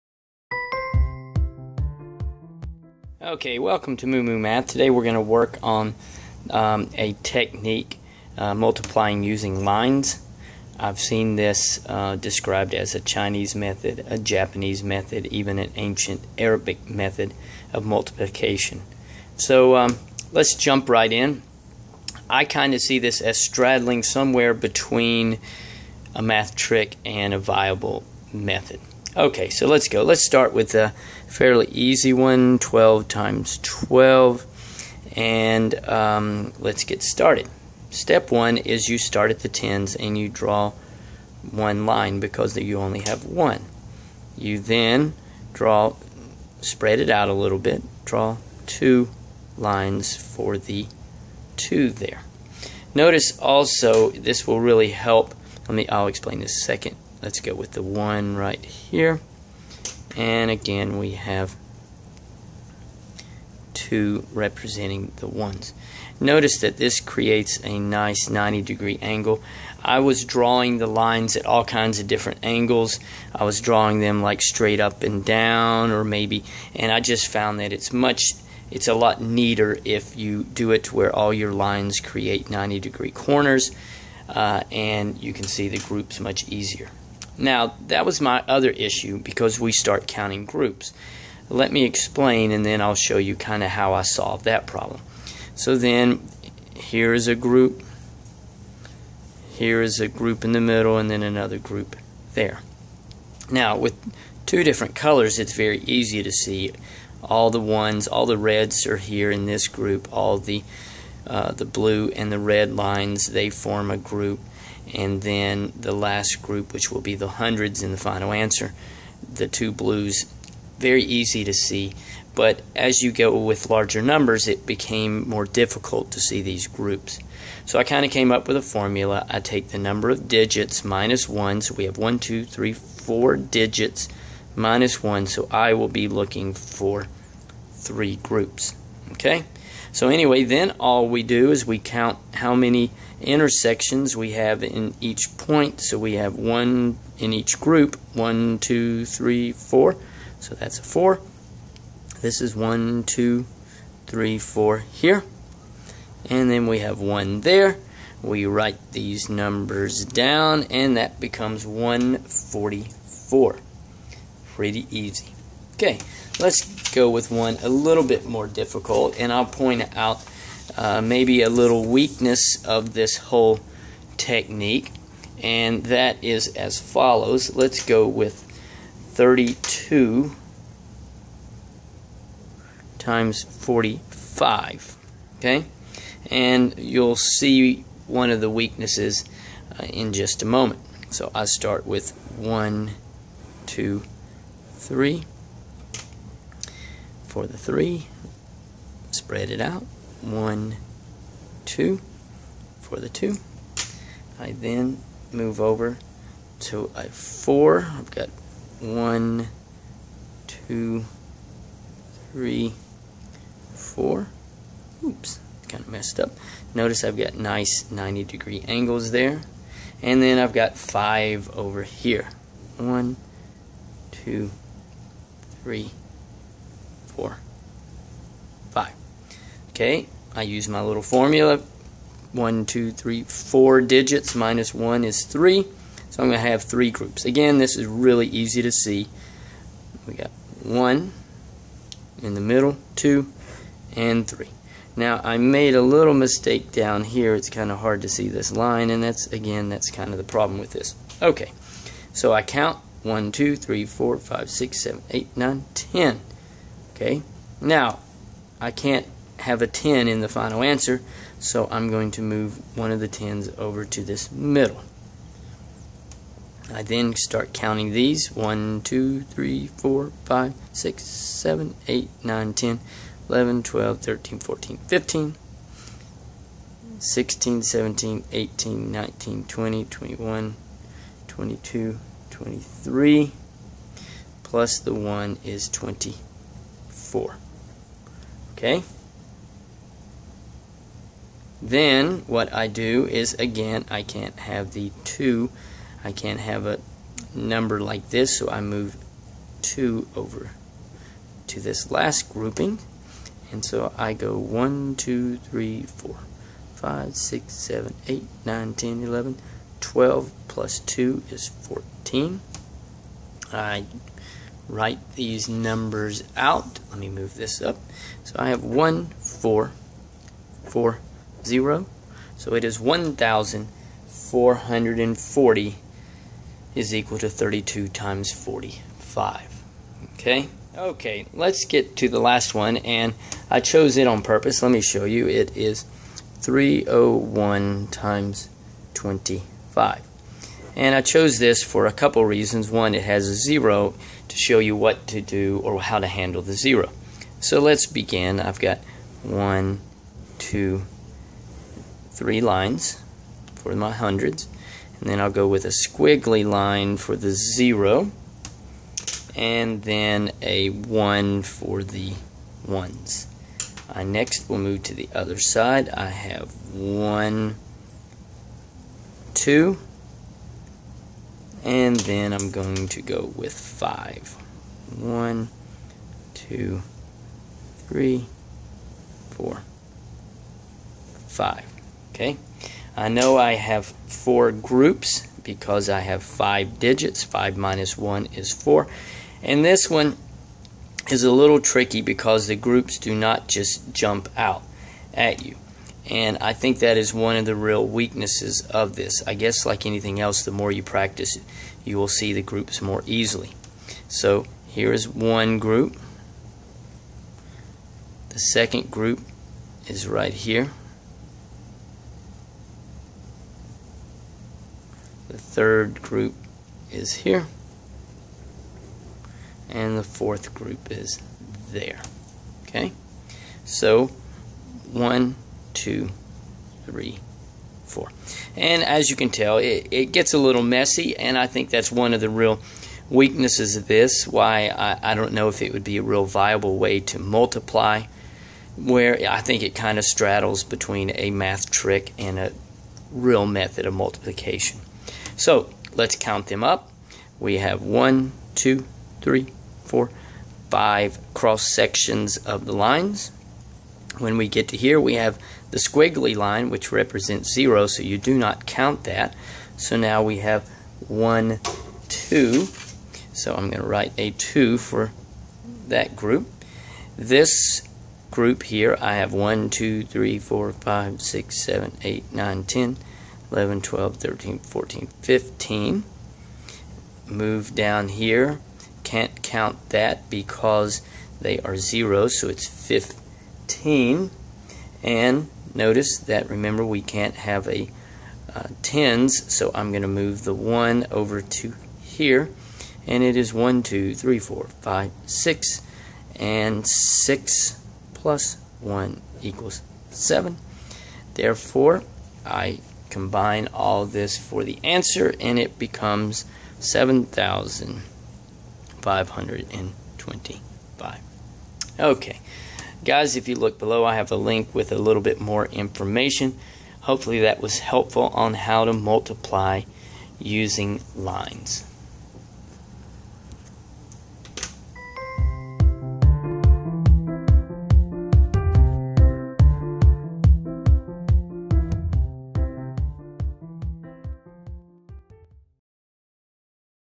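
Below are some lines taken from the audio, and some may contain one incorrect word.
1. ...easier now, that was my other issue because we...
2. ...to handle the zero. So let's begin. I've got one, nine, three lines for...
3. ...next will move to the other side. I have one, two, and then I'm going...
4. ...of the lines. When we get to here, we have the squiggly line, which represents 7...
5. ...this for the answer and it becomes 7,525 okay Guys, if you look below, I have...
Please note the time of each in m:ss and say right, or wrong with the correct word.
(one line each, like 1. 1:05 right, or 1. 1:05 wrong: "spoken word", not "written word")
1. 1:26 right
2. 5:45 wrong: "two", not "nine"
3. 6:04 right
4. 7:32 wrong: "0", not "7"
5. 8:24 right.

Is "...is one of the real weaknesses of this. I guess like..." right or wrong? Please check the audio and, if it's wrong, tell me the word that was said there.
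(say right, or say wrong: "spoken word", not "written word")
right.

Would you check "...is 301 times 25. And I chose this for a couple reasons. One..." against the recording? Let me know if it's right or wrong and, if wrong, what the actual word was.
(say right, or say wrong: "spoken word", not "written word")
right.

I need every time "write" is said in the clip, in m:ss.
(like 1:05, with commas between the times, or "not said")
2:38, 5:14, 7:43.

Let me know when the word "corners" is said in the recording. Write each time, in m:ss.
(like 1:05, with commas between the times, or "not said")
1:23.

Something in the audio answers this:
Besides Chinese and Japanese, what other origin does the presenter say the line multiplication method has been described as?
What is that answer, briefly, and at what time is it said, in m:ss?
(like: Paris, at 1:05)
ancient Arabic, at 0:15.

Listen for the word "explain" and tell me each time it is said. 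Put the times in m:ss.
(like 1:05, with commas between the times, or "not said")
0:56, 1:31.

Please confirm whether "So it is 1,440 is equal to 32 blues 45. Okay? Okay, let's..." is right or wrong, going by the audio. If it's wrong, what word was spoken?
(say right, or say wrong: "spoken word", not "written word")
wrong: "times", not "blues".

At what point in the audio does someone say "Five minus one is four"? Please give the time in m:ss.
6:27.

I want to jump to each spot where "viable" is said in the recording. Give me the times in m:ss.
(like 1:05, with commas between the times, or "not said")
0:27, 7:16.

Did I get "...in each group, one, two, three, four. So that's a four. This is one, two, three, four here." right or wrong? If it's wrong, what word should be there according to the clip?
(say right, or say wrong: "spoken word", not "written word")
right.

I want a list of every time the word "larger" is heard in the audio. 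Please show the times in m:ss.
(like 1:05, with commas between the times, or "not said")
2:03.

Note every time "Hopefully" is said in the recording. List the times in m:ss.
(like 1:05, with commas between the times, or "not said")
8:36.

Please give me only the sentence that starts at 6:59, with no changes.
And the fourth group is there.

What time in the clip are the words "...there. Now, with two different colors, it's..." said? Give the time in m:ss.
1:42.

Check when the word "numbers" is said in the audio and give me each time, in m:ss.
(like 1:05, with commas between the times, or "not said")
2:04, 2:09, 2:39, 4:57, 5:15.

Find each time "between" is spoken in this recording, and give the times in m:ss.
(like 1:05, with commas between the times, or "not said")
0:24, 7:20.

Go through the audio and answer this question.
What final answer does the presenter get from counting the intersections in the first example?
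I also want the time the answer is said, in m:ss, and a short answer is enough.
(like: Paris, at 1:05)
144, at 2:41.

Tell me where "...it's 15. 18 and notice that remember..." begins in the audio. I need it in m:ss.
8:02.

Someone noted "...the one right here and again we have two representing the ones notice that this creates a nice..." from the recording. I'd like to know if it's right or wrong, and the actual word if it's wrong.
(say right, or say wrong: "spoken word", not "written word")
right.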